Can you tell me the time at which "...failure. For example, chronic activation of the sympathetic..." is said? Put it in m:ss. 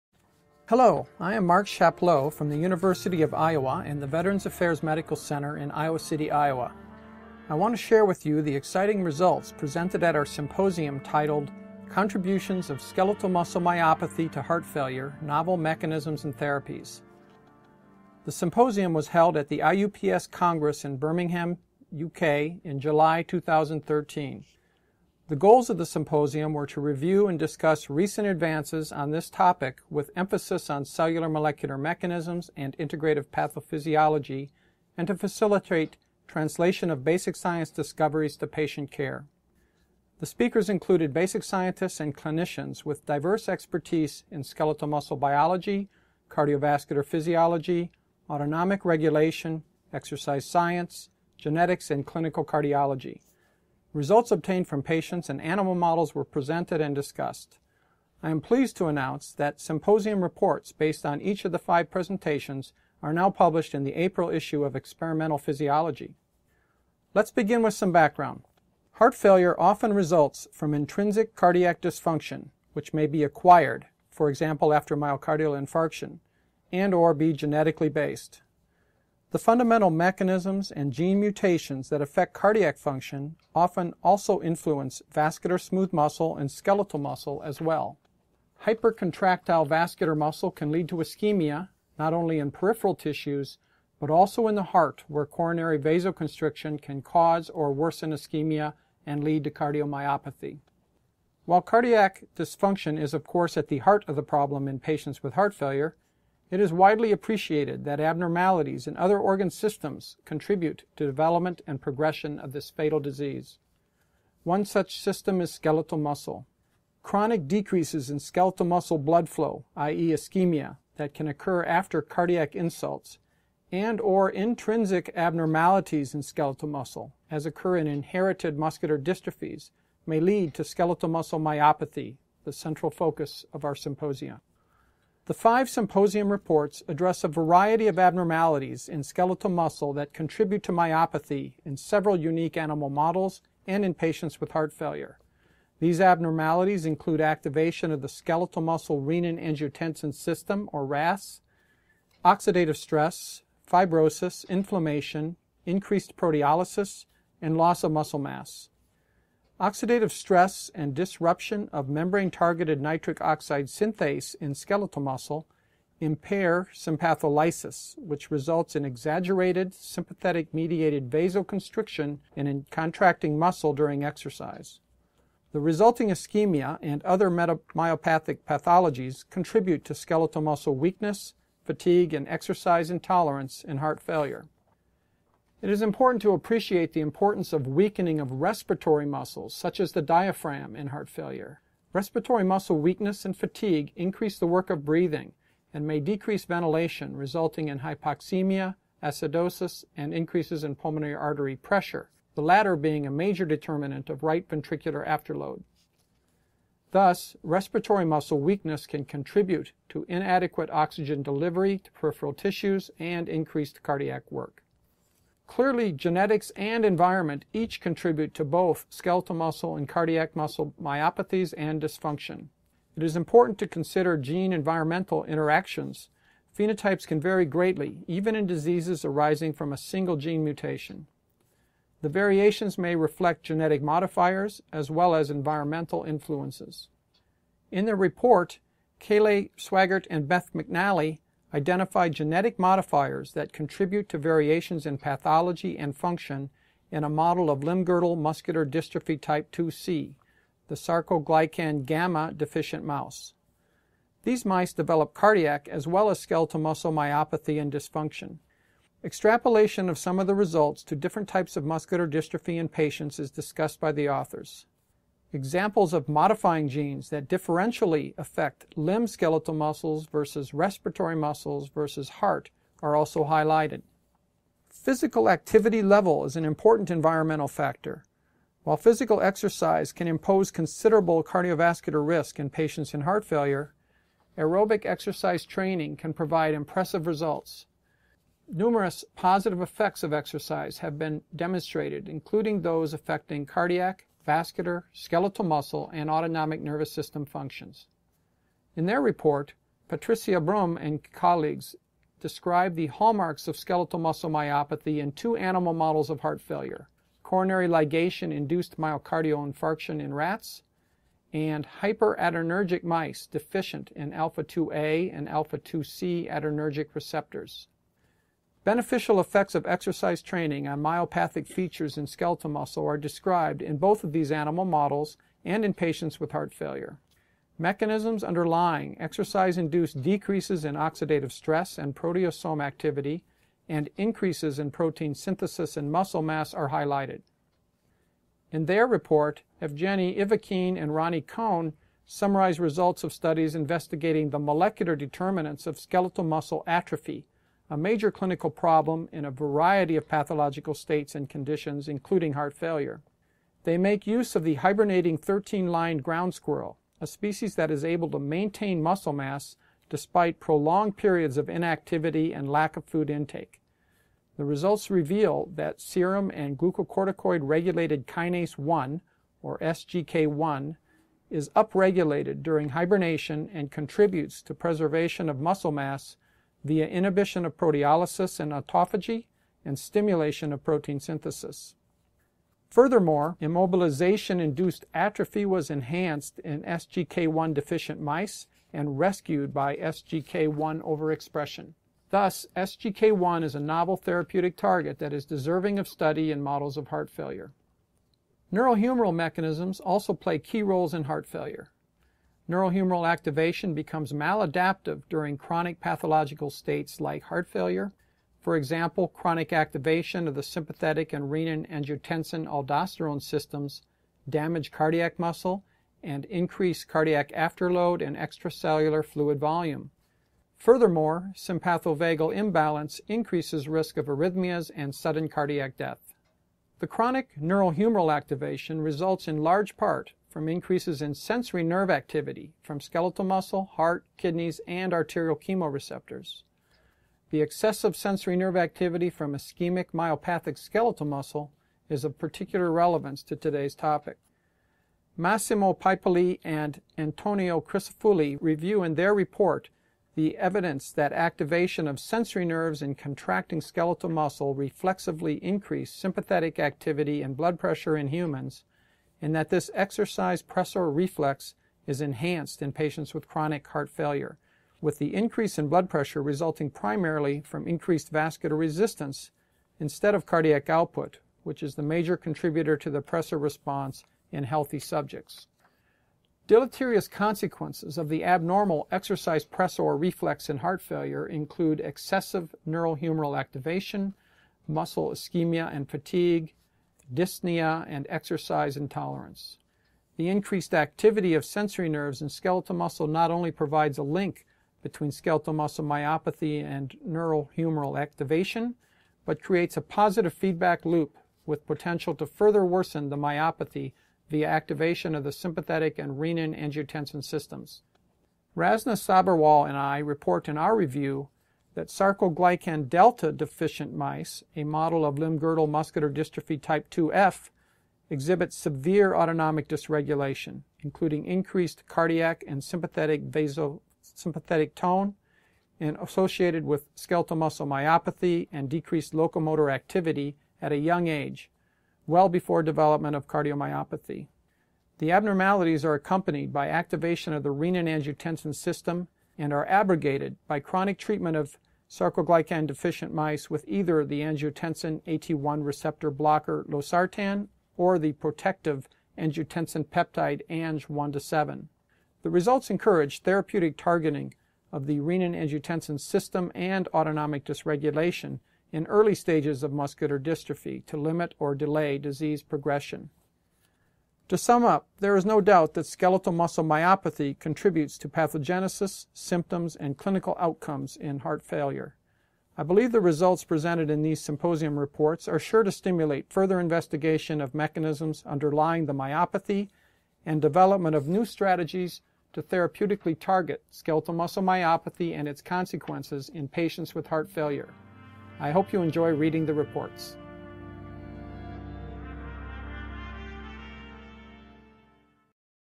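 6:47.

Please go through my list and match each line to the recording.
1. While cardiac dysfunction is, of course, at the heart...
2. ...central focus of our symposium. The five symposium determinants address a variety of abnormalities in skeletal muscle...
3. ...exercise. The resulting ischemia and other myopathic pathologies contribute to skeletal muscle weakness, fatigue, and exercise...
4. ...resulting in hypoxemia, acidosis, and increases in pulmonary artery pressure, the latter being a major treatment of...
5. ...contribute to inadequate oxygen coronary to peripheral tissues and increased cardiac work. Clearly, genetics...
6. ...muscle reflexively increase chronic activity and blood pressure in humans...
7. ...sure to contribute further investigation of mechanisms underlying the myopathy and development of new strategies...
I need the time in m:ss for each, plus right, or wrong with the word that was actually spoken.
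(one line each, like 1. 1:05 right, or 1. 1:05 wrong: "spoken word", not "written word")
1. 1:41 right
2. 2:12 wrong: "reports", not "determinants"
3. 2:54 right
4. 3:17 wrong: "determinant", not "treatment"
5. 3:29 wrong: "delivery", not "coronary"
6. 7:34 wrong: "sympathetic", not "chronic"
7. 9:35 wrong: "stimulate", not "contribute".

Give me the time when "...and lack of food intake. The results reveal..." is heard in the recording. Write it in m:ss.
6:02.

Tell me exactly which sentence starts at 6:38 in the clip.
Neurohumoral mechanisms also play key roles in heart failure.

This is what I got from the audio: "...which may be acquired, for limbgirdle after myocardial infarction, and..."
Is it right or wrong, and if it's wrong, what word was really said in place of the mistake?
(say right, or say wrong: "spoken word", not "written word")
wrong: "example", not "limbgirdle".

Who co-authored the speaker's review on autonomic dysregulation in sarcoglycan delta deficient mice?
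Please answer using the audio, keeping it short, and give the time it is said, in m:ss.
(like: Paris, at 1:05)
Rasna Sabharwal, at 8:28.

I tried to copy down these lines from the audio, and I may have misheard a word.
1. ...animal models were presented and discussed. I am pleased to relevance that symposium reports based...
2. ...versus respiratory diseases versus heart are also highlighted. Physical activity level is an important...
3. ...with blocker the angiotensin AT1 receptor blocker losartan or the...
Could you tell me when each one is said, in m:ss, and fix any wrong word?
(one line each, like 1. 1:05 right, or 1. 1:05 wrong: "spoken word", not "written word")
1. 0:55 wrong: "announce", not "relevance"
2. 4:30 wrong: "muscles", not "diseases"
3. 9:03 wrong: "either", not "blocker".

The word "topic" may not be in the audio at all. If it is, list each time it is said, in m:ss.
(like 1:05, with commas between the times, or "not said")
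0:29, 7:23.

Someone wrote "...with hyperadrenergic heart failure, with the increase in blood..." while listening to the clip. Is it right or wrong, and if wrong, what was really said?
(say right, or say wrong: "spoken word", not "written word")
wrong: "chronic", not "hyperadrenergic".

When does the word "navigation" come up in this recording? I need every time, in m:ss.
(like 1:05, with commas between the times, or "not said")
not said.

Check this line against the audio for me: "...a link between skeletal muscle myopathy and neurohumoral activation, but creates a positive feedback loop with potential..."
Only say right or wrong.
right.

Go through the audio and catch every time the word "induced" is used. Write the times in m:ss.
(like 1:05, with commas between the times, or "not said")
5:08, 5:29, 6:23.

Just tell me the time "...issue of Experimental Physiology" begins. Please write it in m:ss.
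1:04.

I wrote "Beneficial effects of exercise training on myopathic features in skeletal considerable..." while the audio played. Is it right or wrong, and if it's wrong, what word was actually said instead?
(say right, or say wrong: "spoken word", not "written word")
wrong: "muscle", not "considerable".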